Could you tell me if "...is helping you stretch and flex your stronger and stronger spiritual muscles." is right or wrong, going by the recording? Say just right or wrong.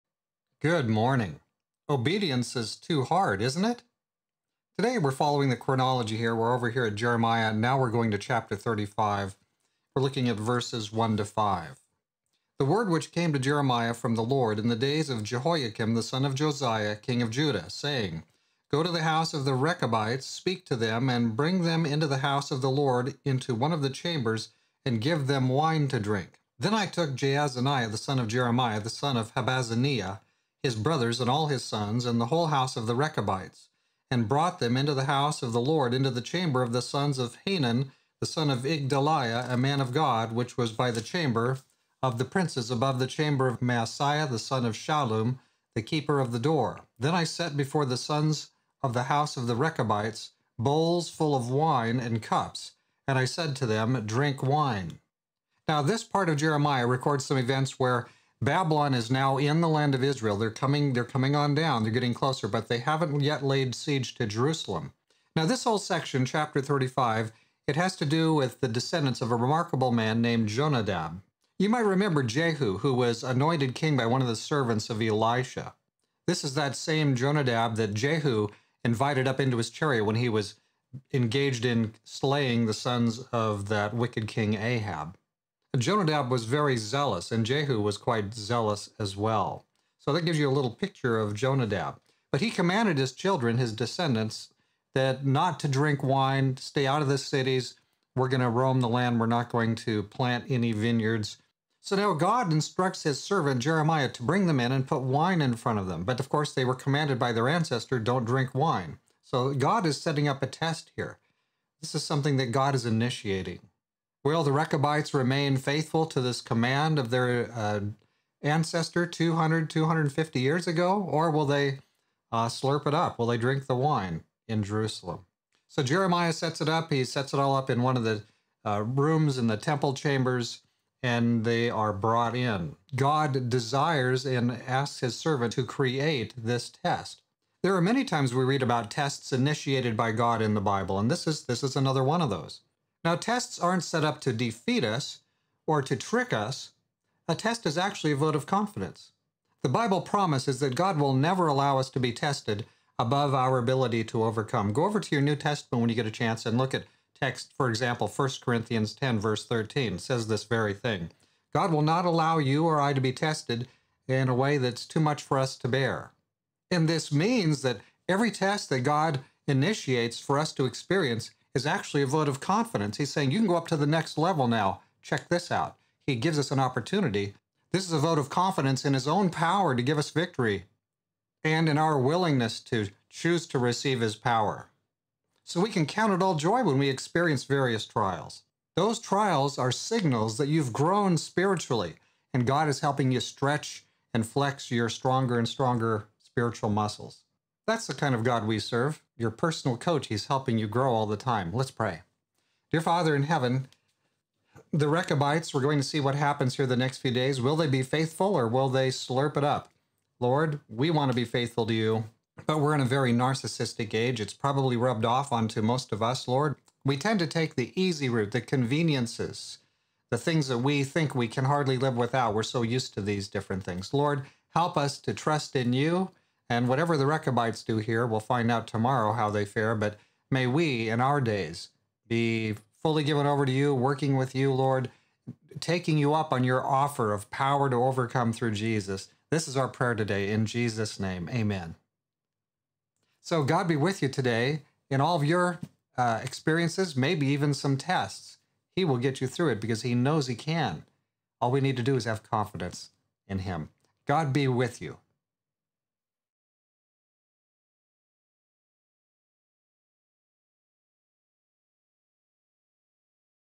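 right.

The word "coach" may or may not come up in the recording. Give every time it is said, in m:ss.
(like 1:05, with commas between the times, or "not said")
3:19.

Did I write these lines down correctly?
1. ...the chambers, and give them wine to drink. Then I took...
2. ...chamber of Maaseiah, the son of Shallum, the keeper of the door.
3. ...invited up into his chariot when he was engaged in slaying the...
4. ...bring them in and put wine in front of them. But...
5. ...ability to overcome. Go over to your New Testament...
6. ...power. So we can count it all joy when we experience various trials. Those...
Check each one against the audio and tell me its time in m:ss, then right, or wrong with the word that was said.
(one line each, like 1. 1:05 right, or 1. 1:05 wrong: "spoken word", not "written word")
1. 0:23 right
2. 0:43 right
3. 1:18 right
4. 1:44 right
5. 2:33 right
6. 3:04 right.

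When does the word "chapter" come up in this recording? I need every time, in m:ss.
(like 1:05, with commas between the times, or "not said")
0:08, 1:06.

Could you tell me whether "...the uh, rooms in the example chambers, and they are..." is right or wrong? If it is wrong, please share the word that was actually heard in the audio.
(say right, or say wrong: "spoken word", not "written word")
wrong: "temple", not "example".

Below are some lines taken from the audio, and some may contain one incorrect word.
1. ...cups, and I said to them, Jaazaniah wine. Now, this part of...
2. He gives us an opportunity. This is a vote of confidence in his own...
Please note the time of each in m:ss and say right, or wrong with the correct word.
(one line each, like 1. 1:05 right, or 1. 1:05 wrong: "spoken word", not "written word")
1. 0:52 wrong: "Drink", not "Jaazaniah"
2. 2:56 right.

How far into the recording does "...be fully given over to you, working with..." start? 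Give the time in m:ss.
3:52.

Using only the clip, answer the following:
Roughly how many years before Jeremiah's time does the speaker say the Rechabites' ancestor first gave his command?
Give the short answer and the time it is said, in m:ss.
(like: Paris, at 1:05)
200 to 250 years, at 1:59.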